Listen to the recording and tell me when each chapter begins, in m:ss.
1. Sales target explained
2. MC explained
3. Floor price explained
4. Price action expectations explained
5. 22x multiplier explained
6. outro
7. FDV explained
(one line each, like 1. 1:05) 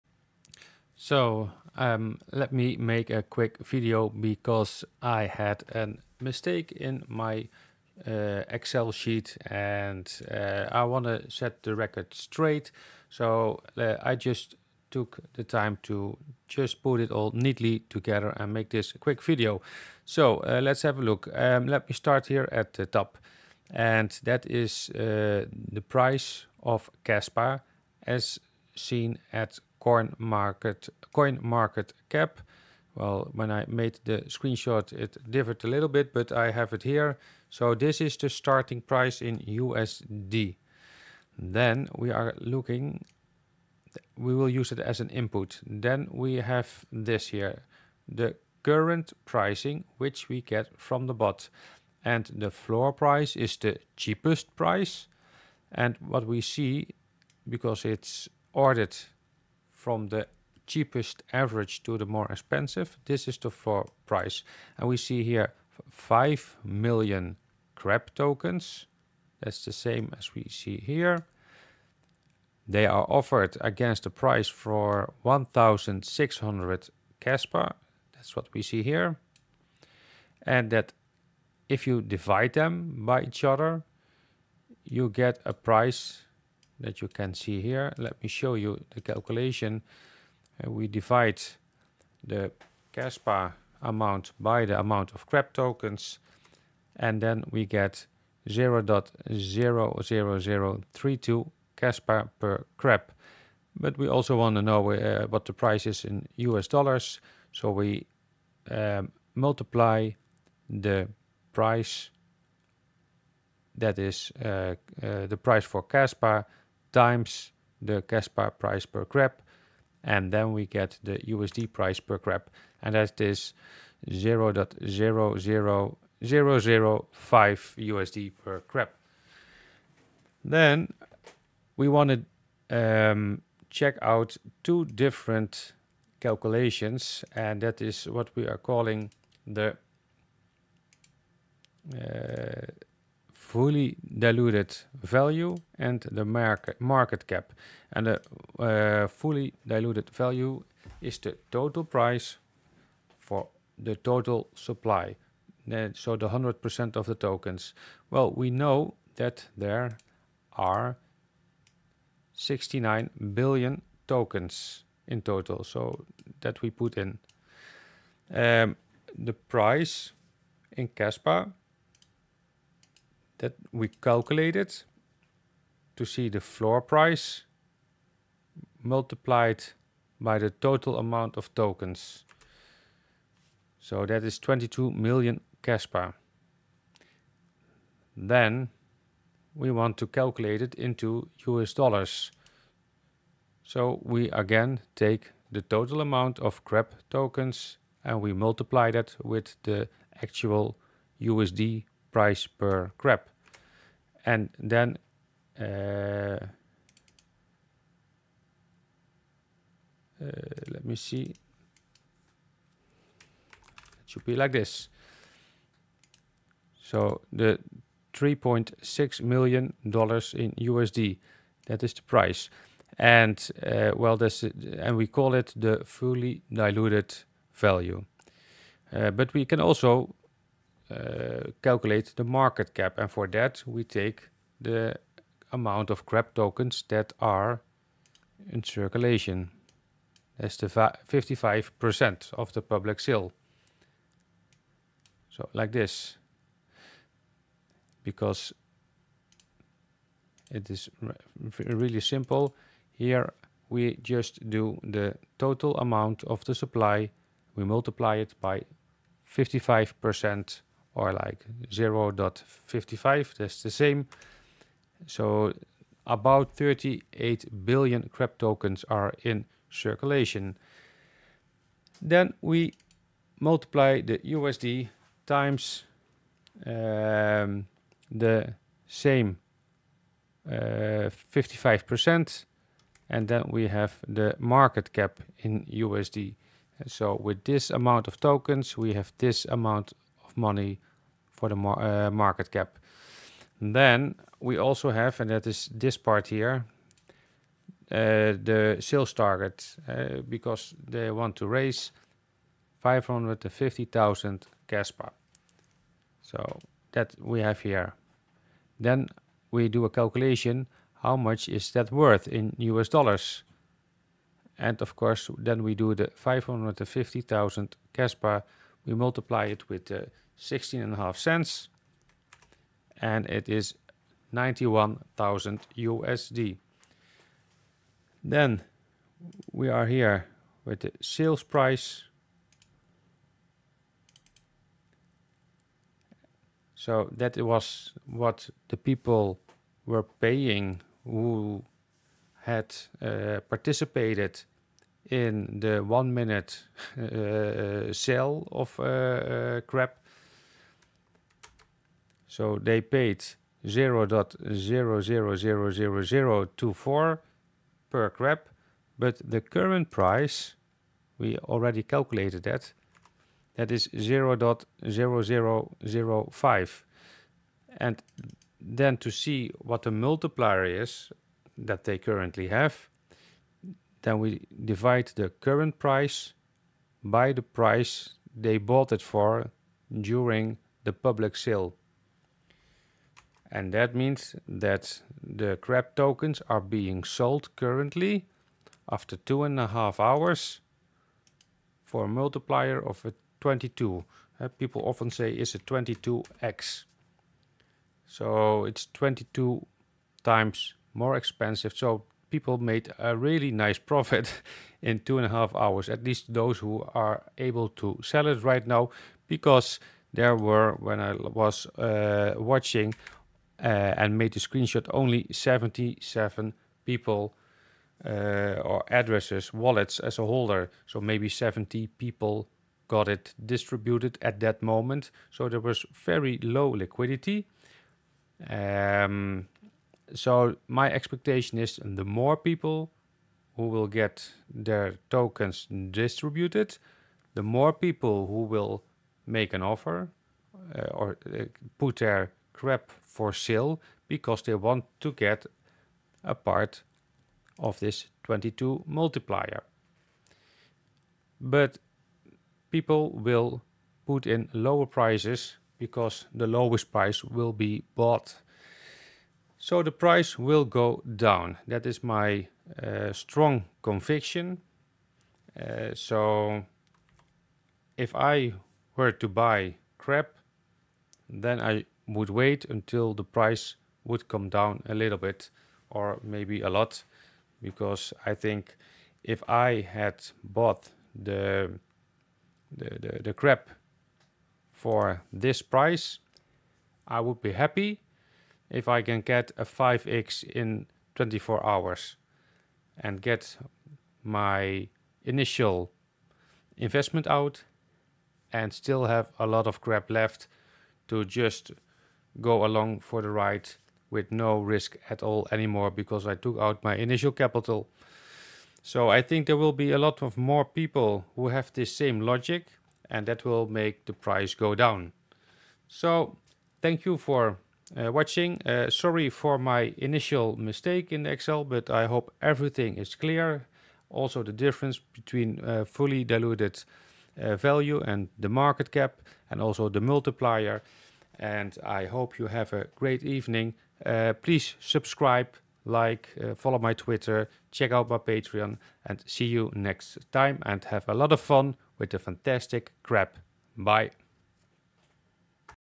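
1. 4:52
2. 3:48
3. 0:45
4. 6:42
5. 5:52
6. 8:36
7. 2:14.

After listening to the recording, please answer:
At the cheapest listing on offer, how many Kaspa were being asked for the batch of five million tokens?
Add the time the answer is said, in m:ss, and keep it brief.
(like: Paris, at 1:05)
1,600, at 1:15.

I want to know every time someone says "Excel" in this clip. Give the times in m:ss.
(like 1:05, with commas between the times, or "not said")
0:08, 8:41.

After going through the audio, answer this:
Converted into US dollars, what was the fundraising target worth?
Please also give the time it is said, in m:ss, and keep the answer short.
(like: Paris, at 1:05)
91,000 USD, at 5:24.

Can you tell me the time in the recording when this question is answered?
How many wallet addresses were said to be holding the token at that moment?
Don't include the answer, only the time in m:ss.
6:55.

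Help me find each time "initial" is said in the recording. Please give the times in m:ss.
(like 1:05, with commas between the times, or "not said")
8:15, 8:26, 8:39.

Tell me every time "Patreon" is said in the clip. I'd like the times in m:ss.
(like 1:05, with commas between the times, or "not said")
8:58.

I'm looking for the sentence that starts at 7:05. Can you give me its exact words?
So there was very low liquidity.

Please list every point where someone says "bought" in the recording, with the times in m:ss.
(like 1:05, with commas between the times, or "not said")
6:18, 7:37, 8:00.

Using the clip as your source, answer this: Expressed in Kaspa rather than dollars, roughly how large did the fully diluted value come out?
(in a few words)
22 million Kaspa.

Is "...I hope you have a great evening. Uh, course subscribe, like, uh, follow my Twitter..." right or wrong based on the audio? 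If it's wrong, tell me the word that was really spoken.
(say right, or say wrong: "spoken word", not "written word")
wrong: "please", not "course".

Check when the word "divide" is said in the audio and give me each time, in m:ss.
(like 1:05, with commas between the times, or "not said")
1:22, 1:30, 6:14.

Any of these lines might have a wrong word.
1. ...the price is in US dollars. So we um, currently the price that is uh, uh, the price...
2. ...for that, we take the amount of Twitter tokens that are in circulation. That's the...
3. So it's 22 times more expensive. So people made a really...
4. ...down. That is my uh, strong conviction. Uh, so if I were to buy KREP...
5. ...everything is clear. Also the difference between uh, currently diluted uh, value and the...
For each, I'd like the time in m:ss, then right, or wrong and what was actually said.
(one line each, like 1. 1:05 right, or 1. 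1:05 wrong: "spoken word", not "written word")
1. 1:45 wrong: "multiply", not "currently"
2. 3:53 wrong: "KREP", not "Twitter"
3. 6:38 right
4. 7:41 right
5. 8:42 wrong: "fully", not "currently".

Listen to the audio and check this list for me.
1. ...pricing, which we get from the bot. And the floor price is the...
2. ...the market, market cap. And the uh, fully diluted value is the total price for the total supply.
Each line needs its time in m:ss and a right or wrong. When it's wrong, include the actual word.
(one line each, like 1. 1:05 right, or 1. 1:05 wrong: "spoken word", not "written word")
1. 0:49 right
2. 2:26 right.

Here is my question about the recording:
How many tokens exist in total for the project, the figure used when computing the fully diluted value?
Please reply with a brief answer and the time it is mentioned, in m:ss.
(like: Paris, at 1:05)
69 billion, at 2:42.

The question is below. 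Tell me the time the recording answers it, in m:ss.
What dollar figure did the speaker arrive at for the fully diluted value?
3:38.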